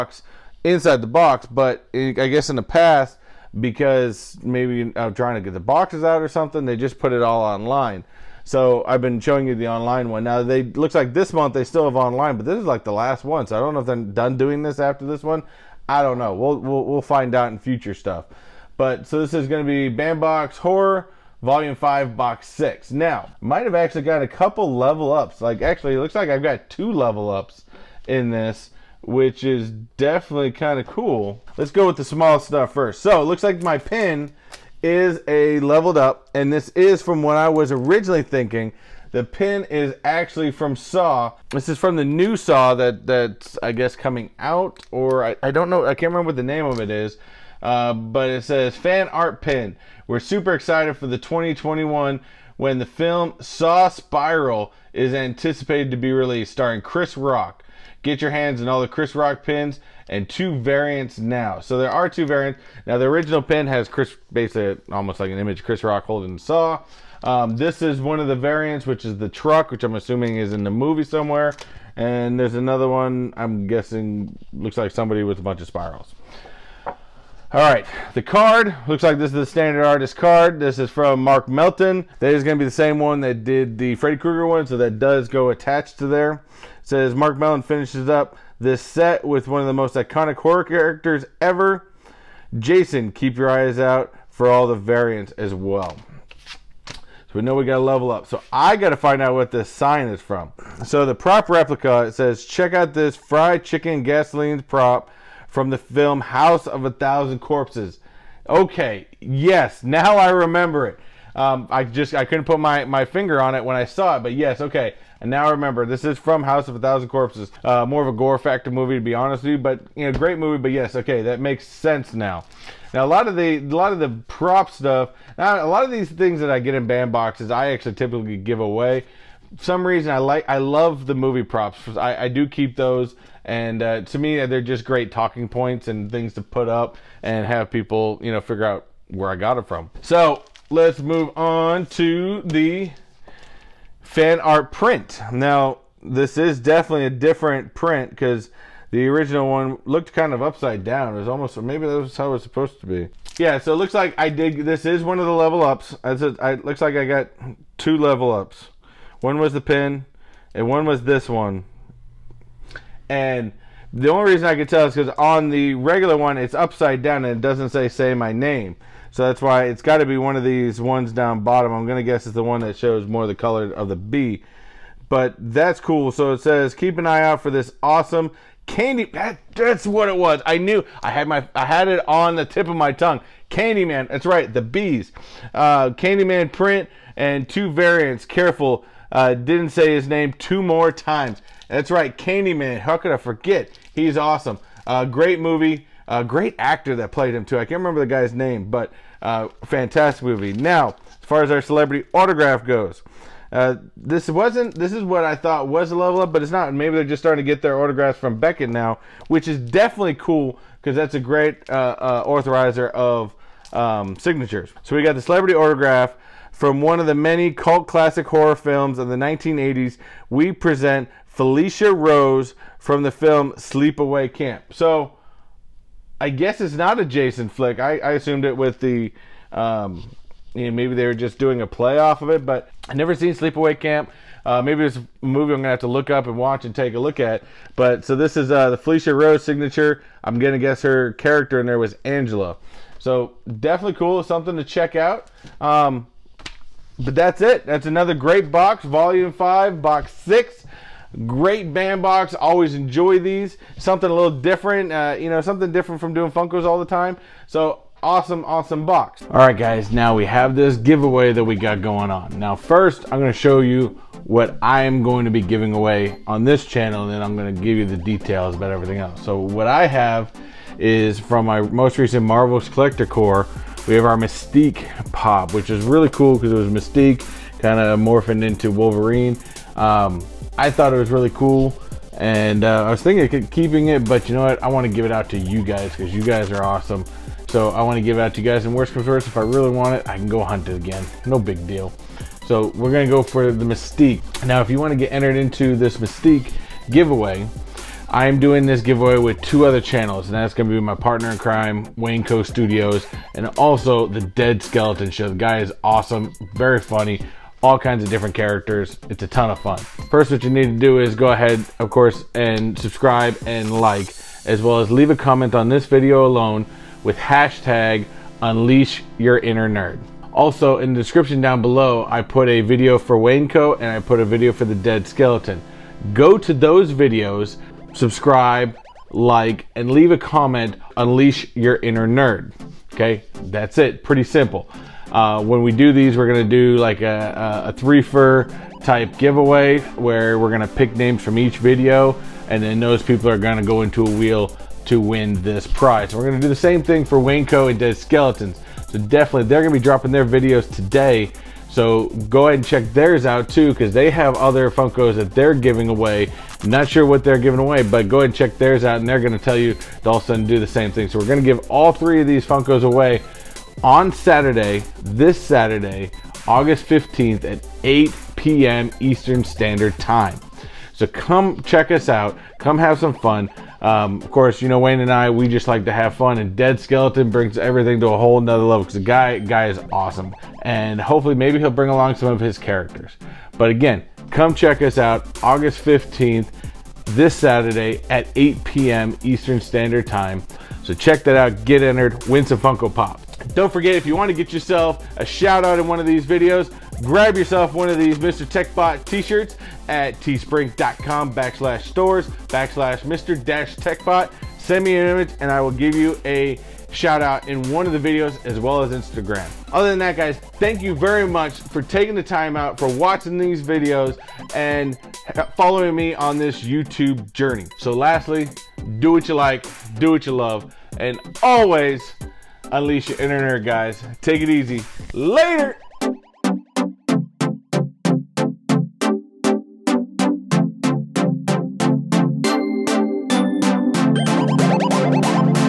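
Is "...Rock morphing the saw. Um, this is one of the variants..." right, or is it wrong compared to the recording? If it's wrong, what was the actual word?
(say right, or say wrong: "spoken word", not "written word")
wrong: "holding", not "morphing".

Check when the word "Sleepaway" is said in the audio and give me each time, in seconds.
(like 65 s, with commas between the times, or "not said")
223 s, 233 s.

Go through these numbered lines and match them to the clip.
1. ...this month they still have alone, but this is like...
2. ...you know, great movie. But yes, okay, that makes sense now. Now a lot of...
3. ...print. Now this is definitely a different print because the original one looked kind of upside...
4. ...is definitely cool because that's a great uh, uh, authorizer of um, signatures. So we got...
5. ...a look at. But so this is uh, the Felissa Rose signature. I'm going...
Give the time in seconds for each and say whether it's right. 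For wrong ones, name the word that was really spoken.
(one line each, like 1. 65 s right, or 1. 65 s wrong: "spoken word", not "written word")
1. 11 s wrong: "online", not "alone"
2. 119 s right
3. 144 s right
4. 209 s right
5. 236 s right.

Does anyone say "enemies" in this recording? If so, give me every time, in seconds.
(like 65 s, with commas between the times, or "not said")
not said.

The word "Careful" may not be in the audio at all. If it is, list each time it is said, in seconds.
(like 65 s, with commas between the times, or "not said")
188 s.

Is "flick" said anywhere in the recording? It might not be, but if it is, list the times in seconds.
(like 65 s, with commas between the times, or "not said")
227 s.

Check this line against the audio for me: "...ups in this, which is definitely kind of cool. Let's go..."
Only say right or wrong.
right.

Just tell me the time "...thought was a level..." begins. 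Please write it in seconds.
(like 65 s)
205 s.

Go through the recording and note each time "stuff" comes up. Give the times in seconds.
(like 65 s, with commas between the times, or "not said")
17 s, 32 s, 124 s.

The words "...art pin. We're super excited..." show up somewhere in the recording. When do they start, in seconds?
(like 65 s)
49 s.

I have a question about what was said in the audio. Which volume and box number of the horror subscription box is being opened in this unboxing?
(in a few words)
Volume 5, Box 6.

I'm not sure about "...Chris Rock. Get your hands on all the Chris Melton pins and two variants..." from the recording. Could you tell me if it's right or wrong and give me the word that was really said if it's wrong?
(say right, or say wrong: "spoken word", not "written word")
wrong: "Rock", not "Melton".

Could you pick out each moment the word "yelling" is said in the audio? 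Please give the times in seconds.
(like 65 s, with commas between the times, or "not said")
not said.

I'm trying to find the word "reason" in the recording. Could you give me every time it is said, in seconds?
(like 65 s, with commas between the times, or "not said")
129 s, 164 s.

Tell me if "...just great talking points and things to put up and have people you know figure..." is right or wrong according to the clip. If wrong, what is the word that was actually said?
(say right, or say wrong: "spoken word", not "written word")
right.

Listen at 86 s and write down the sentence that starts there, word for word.
It says Mark Melton finishes up this set with one of the most iconic horror characters ever.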